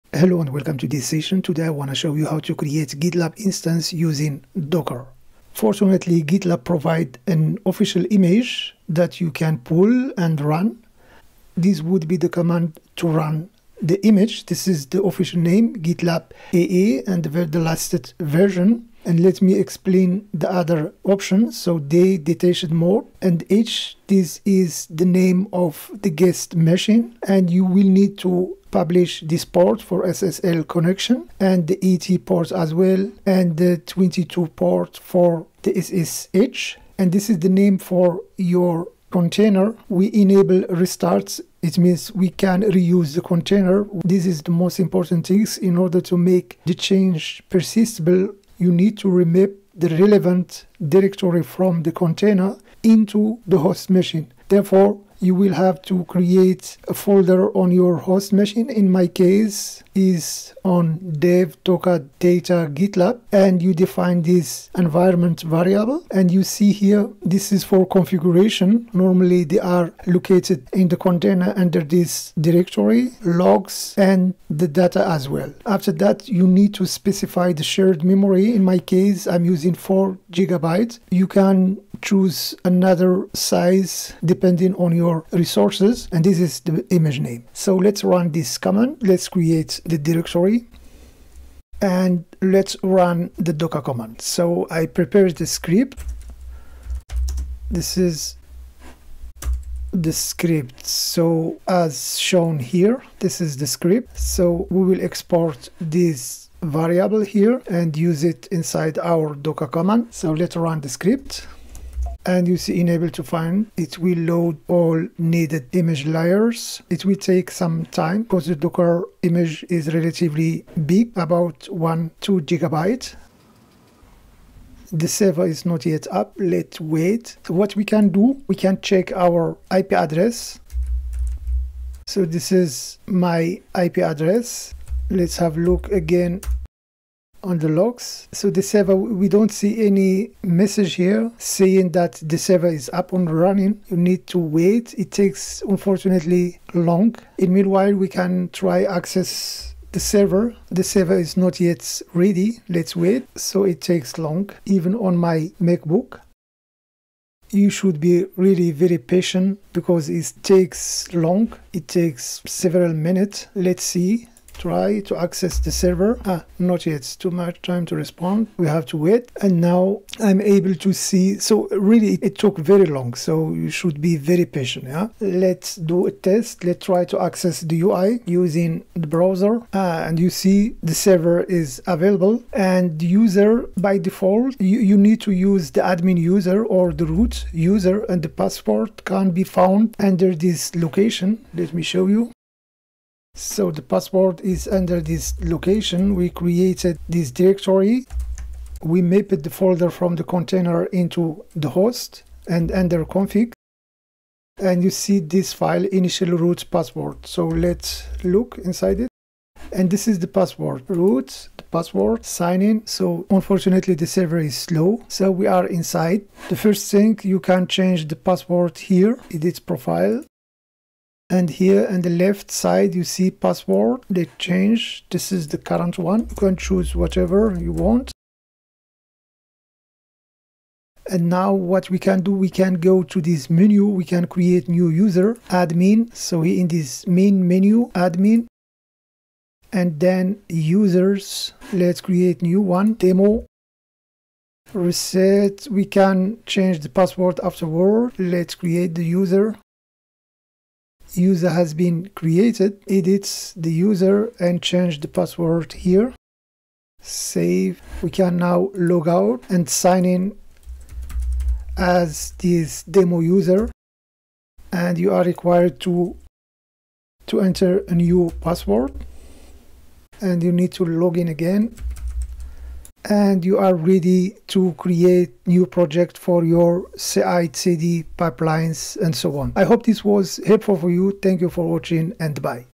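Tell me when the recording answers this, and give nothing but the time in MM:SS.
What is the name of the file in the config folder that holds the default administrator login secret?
03:25.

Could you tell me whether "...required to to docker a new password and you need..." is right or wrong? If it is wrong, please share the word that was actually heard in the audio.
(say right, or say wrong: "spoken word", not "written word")
wrong: "enter", not "docker".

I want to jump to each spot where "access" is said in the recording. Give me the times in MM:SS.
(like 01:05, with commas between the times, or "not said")
02:28, 02:45, 02:57.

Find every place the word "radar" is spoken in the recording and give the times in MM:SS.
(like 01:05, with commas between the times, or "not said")
not said.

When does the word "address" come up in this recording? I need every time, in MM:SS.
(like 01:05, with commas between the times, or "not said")
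02:09, 02:13.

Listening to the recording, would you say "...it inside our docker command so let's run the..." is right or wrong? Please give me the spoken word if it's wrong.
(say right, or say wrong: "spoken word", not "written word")
right.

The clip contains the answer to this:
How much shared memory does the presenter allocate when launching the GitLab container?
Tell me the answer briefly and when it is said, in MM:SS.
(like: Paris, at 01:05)
4 gigabytes, at 01:19.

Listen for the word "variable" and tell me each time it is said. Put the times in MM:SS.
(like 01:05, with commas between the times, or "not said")
01:05, 01:46.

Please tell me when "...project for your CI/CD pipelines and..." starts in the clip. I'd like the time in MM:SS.
04:35.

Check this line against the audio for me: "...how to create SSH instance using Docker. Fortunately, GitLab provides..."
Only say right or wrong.
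wrong.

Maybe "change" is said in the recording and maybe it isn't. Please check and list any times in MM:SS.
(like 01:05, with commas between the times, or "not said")
00:46, 03:37, 03:44, 04:06, 04:14.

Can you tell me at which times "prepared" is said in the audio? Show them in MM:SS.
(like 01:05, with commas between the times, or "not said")
01:34.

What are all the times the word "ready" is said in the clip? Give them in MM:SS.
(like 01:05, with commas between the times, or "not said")
02:32, 04:33.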